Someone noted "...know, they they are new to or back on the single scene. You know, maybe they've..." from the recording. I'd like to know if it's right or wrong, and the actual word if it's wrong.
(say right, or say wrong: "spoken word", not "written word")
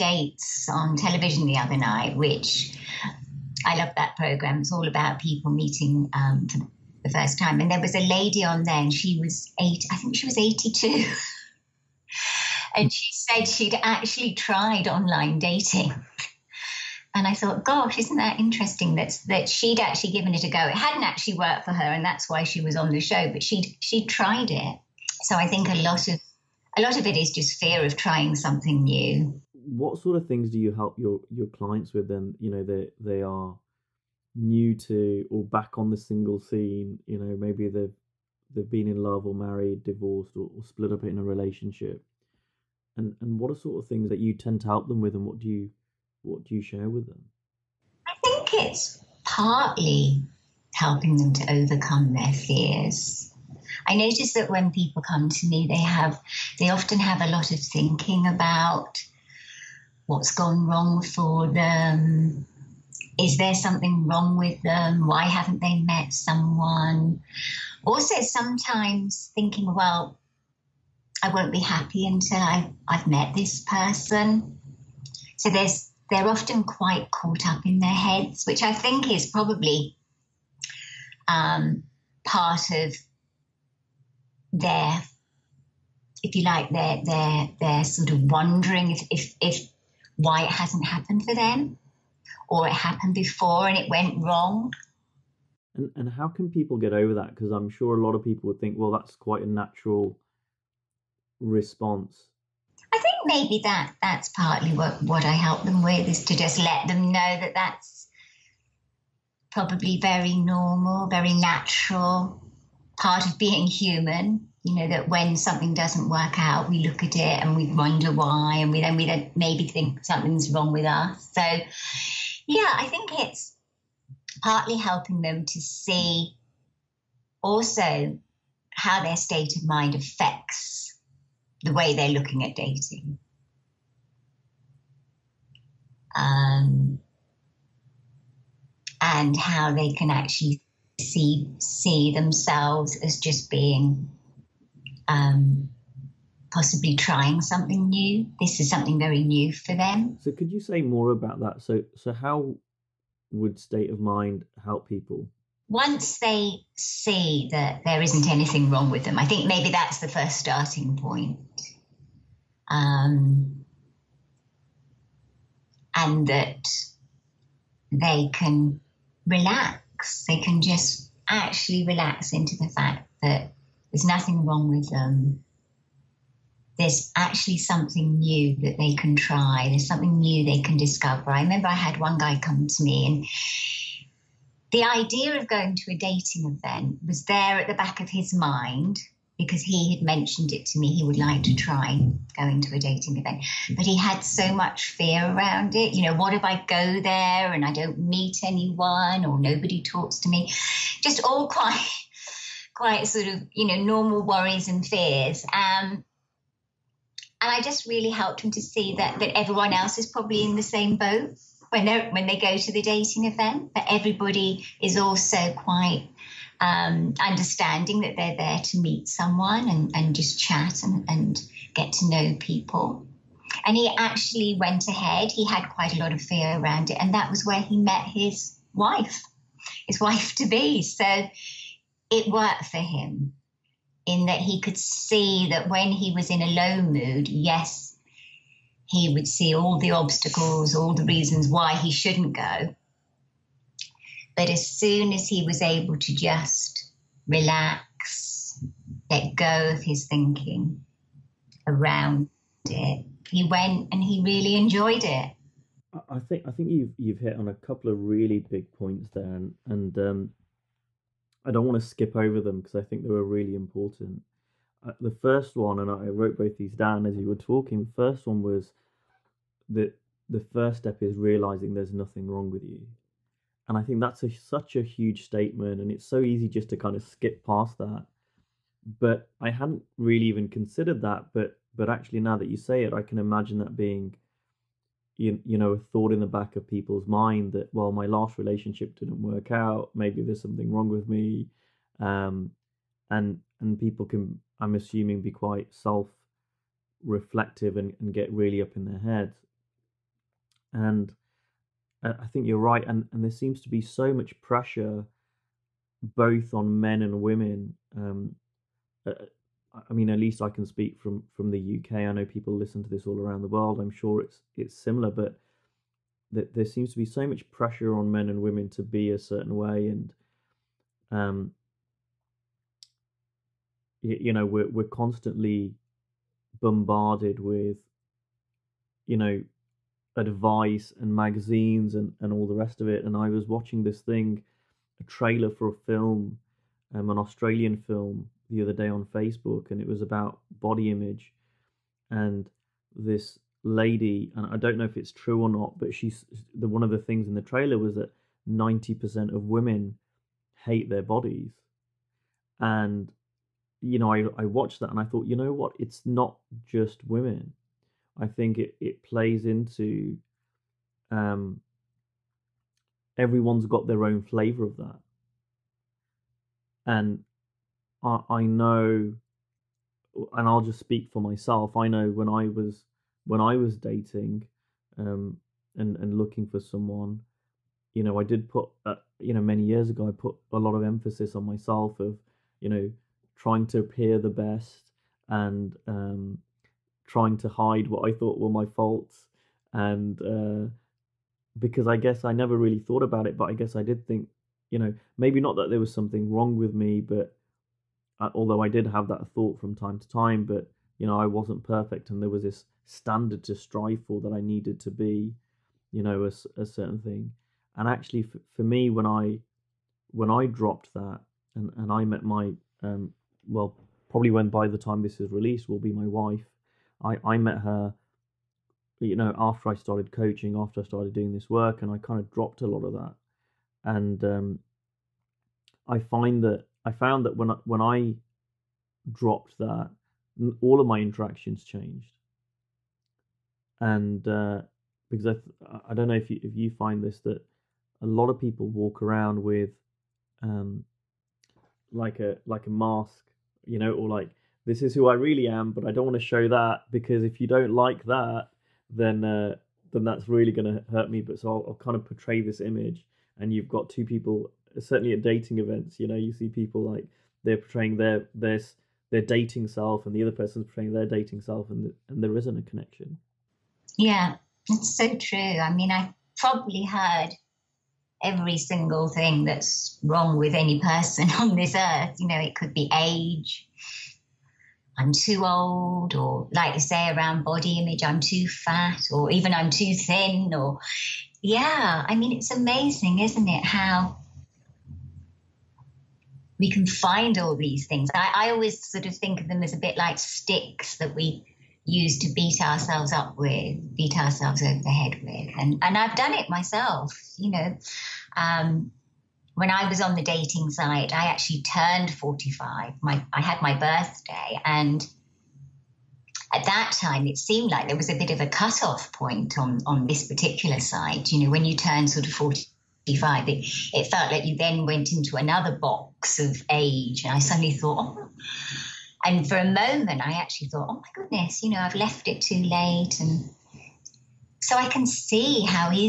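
right.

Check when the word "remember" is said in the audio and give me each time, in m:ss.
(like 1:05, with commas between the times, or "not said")
3:01.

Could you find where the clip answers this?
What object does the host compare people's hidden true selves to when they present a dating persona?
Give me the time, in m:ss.
7:22.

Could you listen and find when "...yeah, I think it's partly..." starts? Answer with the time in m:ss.
2:02.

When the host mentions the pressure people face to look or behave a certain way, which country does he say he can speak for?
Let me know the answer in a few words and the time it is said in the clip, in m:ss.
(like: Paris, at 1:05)
UK, at 5:11.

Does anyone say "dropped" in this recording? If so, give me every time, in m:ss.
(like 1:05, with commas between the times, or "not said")
6:50, 7:02, 7:09.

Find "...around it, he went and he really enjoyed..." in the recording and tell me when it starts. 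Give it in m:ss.
4:11.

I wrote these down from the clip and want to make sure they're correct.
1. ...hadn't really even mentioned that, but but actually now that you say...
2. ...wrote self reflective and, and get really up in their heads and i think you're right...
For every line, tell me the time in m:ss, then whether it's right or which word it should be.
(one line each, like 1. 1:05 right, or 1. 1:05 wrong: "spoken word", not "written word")
1. 4:39 wrong: "considered", not "mentioned"
2. 4:55 wrong: "quite", not "wrote".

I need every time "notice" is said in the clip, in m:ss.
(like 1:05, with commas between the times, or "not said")
0:53.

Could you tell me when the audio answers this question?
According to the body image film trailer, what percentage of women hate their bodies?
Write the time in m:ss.
5:48.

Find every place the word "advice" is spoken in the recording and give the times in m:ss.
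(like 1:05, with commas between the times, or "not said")
5:30.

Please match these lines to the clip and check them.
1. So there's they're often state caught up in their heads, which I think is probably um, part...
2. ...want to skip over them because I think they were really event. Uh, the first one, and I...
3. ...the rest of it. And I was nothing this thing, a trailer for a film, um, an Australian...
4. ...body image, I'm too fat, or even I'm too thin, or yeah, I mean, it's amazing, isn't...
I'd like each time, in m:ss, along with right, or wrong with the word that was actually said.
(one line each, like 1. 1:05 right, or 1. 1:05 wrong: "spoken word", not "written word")
1. 1:15 wrong: "quite", not "state"
2. 4:21 wrong: "important", not "event"
3. 5:32 wrong: "watching", not "nothing"
4. 7:57 right.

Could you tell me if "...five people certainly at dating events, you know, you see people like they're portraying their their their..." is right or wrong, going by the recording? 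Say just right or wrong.
wrong.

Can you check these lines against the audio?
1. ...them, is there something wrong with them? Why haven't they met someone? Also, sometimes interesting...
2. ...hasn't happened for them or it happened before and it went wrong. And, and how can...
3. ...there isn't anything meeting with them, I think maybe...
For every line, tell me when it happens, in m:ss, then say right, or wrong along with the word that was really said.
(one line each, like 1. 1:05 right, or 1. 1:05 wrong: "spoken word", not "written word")
1. 1:01 wrong: "thinking", not "interesting"
2. 1:30 right
3. 2:37 wrong: "wrong", not "meeting".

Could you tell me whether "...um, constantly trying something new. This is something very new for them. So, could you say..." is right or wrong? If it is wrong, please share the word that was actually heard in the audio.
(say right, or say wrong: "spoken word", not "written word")
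wrong: "possibly", not "constantly".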